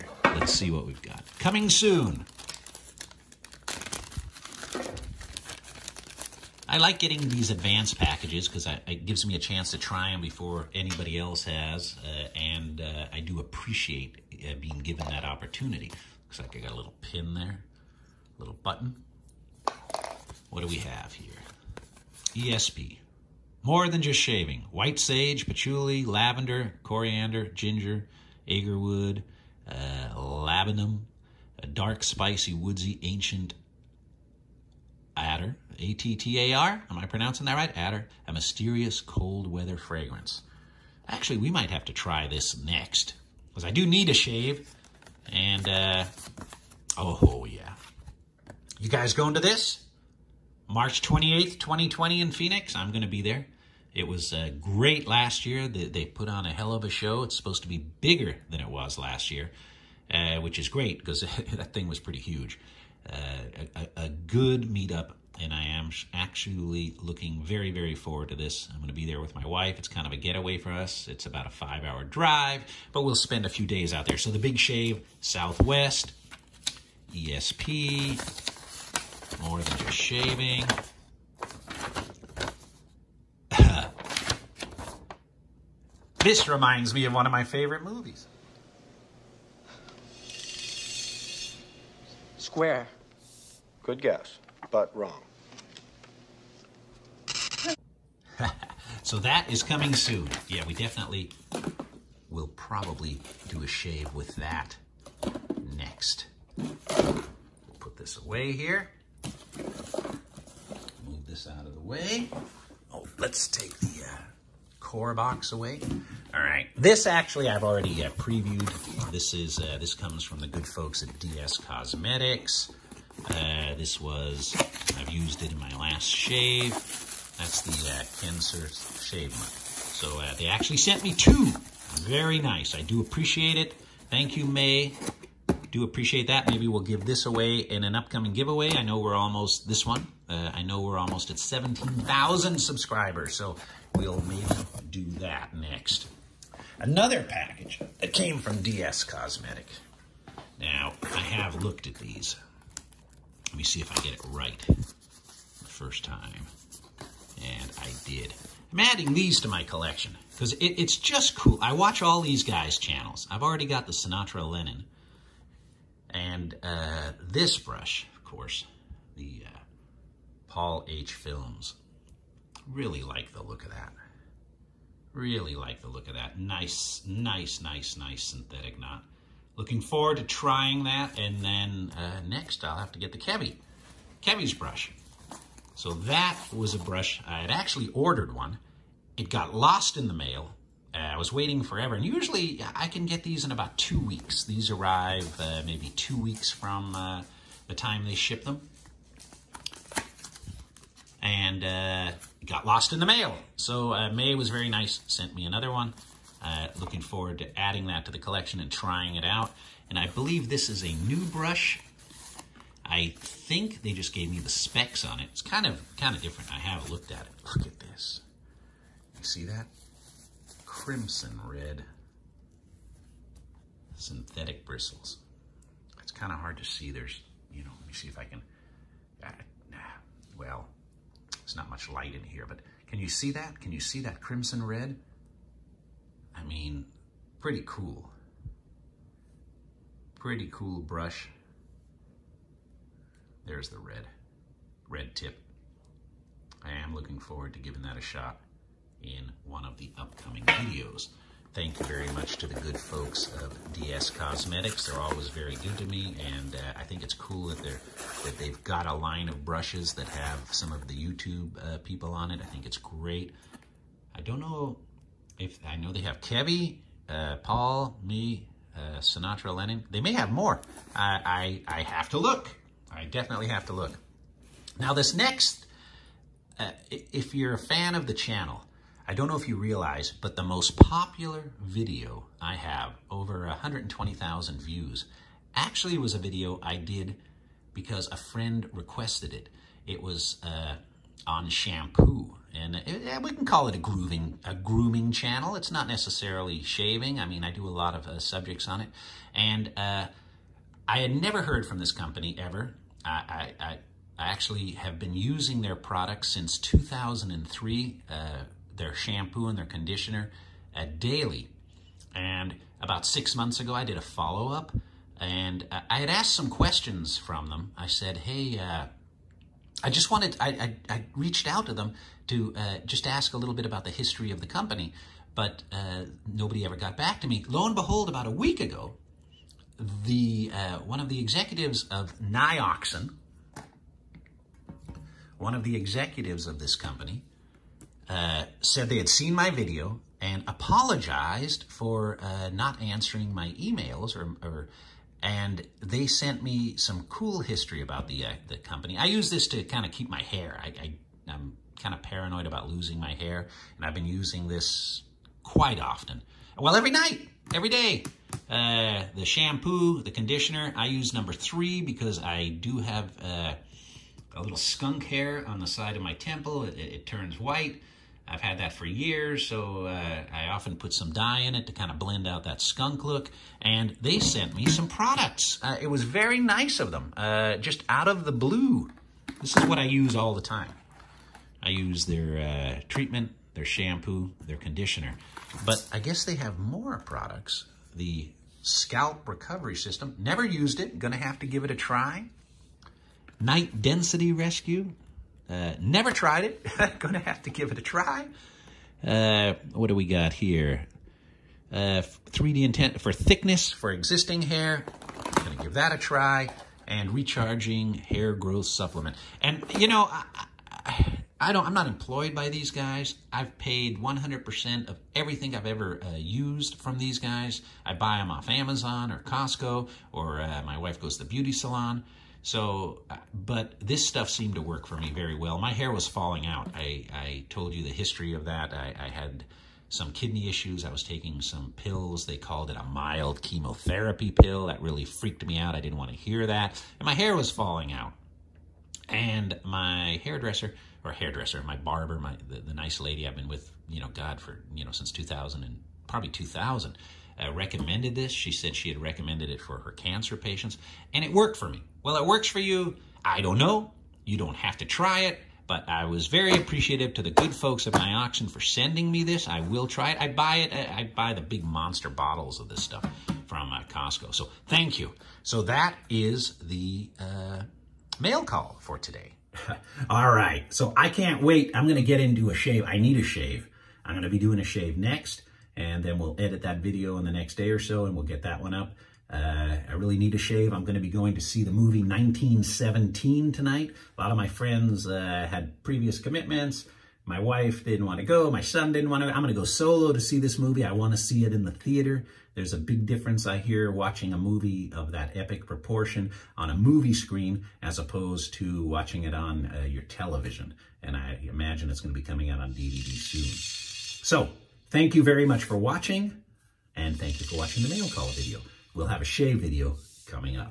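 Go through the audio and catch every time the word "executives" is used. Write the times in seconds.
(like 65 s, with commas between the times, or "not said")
331 s, 335 s.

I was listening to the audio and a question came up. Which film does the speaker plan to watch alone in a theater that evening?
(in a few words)
1917.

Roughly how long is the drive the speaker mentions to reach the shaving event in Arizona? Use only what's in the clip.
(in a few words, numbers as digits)
5 hours.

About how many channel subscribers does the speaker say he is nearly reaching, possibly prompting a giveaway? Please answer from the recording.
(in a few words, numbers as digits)
17,000.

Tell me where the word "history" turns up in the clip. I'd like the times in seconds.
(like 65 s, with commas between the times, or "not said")
323 s, 347 s, 427 s.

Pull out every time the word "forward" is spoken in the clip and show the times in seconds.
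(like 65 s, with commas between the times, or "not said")
67 s, 179 s, 207 s, 247 s.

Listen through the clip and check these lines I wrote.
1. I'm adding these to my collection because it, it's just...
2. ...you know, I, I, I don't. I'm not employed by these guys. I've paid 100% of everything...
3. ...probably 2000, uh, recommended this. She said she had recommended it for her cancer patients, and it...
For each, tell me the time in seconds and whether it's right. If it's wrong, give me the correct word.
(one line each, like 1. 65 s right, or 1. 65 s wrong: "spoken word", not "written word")
1. 158 s right
2. 409 s right
3. 446 s right.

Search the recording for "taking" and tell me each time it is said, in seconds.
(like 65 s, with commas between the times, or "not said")
431 s.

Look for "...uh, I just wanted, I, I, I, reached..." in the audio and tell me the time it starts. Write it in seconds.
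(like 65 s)
318 s.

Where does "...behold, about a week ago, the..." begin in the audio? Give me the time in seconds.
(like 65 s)
327 s.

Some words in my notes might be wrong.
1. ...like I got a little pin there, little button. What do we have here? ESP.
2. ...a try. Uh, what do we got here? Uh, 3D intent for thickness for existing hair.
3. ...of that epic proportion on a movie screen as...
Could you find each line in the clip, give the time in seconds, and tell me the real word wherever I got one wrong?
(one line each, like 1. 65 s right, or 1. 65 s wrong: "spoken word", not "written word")
1. 16 s right
2. 397 s right
3. 494 s right.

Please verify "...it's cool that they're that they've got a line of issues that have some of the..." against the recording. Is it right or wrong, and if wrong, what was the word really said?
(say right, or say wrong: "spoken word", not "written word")
wrong: "brushes", not "issues".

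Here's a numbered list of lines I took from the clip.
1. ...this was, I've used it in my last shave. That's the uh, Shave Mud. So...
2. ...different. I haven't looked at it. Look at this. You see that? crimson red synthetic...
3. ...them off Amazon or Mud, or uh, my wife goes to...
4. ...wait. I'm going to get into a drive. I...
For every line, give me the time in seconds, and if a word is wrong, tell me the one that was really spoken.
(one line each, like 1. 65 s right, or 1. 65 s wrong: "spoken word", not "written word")
1. 123 s right
2. 216 s right
3. 418 s wrong: "Costco", not "Mud"
4. 471 s wrong: "shave", not "drive".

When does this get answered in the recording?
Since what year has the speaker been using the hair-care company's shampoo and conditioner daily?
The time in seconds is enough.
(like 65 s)
306 s.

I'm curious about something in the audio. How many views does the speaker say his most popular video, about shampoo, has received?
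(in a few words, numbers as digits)
Over 120,000.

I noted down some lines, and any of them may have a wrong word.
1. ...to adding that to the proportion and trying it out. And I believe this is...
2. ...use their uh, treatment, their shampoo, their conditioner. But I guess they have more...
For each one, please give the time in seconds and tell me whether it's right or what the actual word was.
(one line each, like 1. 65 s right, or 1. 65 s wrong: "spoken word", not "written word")
1. 207 s wrong: "collection", not "proportion"
2. 381 s right.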